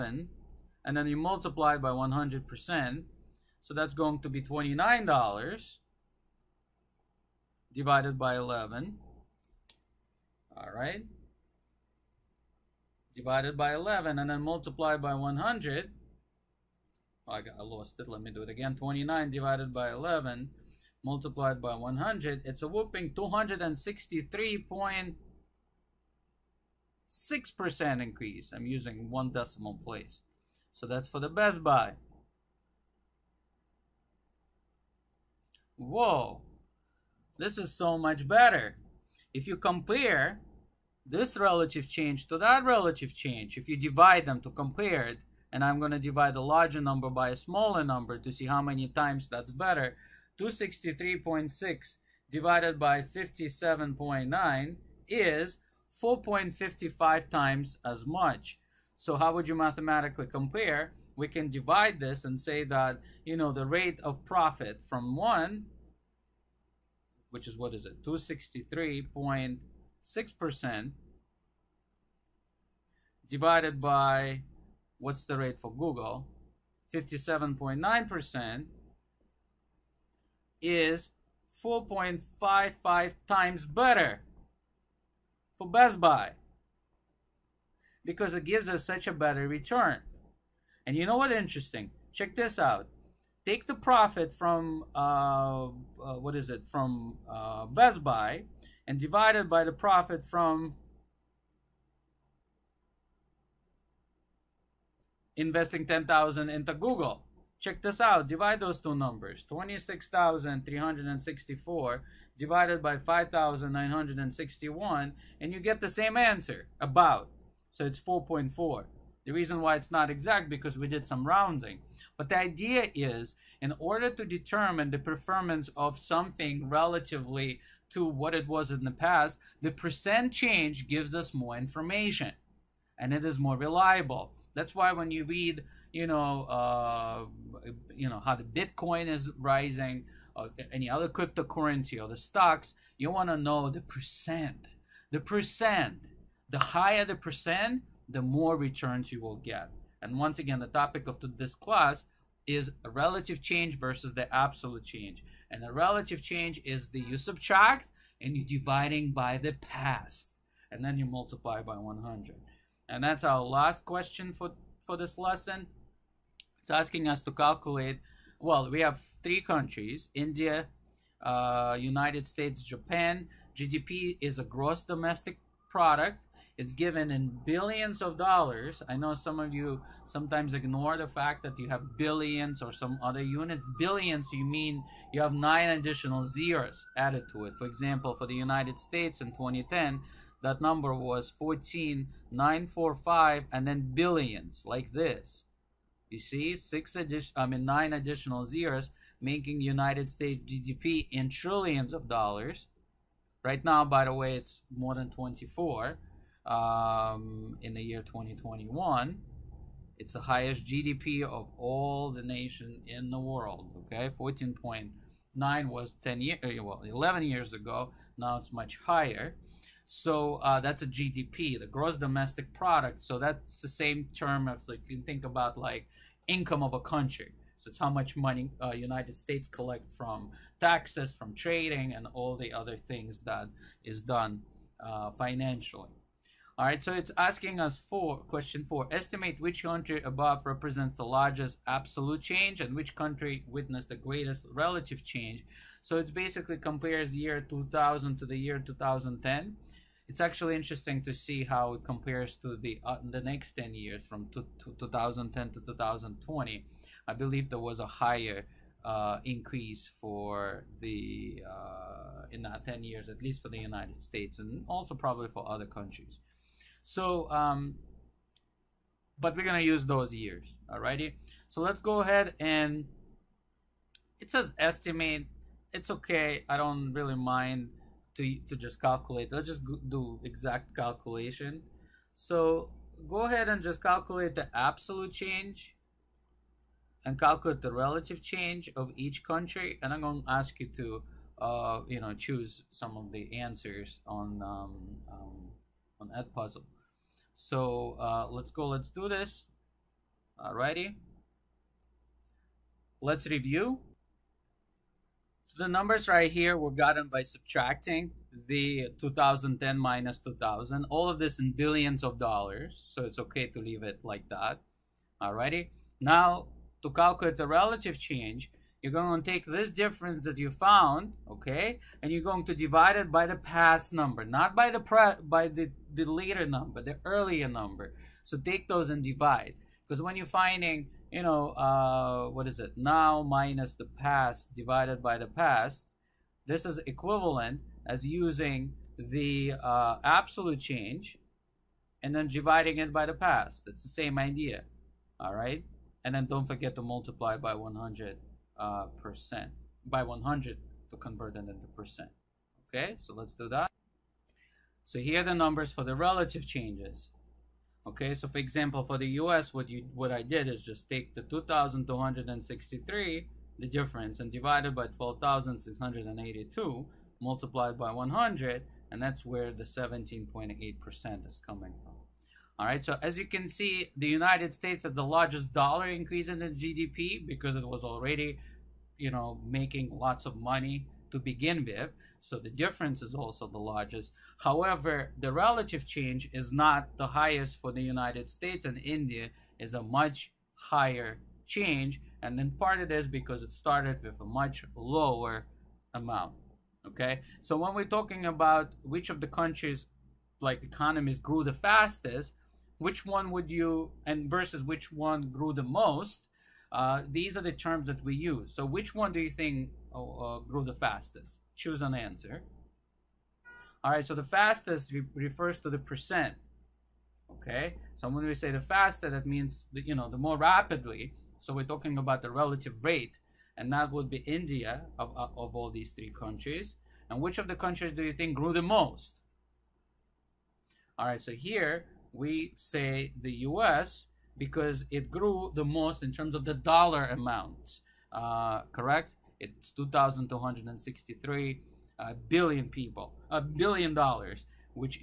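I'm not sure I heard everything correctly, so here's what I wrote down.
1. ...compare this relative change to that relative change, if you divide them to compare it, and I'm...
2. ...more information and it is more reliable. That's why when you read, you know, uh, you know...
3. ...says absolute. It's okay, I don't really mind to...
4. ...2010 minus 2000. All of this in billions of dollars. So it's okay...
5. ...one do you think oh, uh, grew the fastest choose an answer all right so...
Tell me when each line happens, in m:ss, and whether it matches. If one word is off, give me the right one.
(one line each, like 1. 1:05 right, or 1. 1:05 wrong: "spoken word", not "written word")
1. 0:39 right
2. 2:11 right
3. 4:34 wrong: "estimate", not "absolute"
4. 5:08 right
5. 6:48 right.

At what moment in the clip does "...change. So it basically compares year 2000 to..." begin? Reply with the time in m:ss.
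4:05.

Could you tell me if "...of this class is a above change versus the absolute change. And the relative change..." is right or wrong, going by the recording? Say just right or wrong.
wrong.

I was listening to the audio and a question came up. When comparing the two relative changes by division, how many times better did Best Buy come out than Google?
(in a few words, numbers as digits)
4.55.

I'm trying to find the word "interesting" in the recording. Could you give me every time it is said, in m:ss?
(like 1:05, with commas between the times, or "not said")
1:31, 4:10.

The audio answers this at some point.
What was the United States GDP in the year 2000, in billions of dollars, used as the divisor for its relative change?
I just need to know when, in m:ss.
6:04.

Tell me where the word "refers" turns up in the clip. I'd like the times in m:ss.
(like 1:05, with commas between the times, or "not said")
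6:55.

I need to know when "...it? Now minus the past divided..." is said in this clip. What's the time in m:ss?
5:32.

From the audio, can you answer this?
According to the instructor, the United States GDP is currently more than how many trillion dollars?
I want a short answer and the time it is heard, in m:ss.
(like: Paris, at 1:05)
24, at 3:24.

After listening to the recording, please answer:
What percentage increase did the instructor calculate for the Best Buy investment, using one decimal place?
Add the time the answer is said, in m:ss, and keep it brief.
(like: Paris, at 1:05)
263.6%, at 0:23.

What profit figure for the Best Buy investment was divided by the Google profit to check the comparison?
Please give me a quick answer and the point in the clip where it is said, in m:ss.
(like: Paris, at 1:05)
26,364, at 1:49.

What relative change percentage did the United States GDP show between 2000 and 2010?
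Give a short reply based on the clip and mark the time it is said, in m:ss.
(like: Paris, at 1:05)
17.8%, at 6:09.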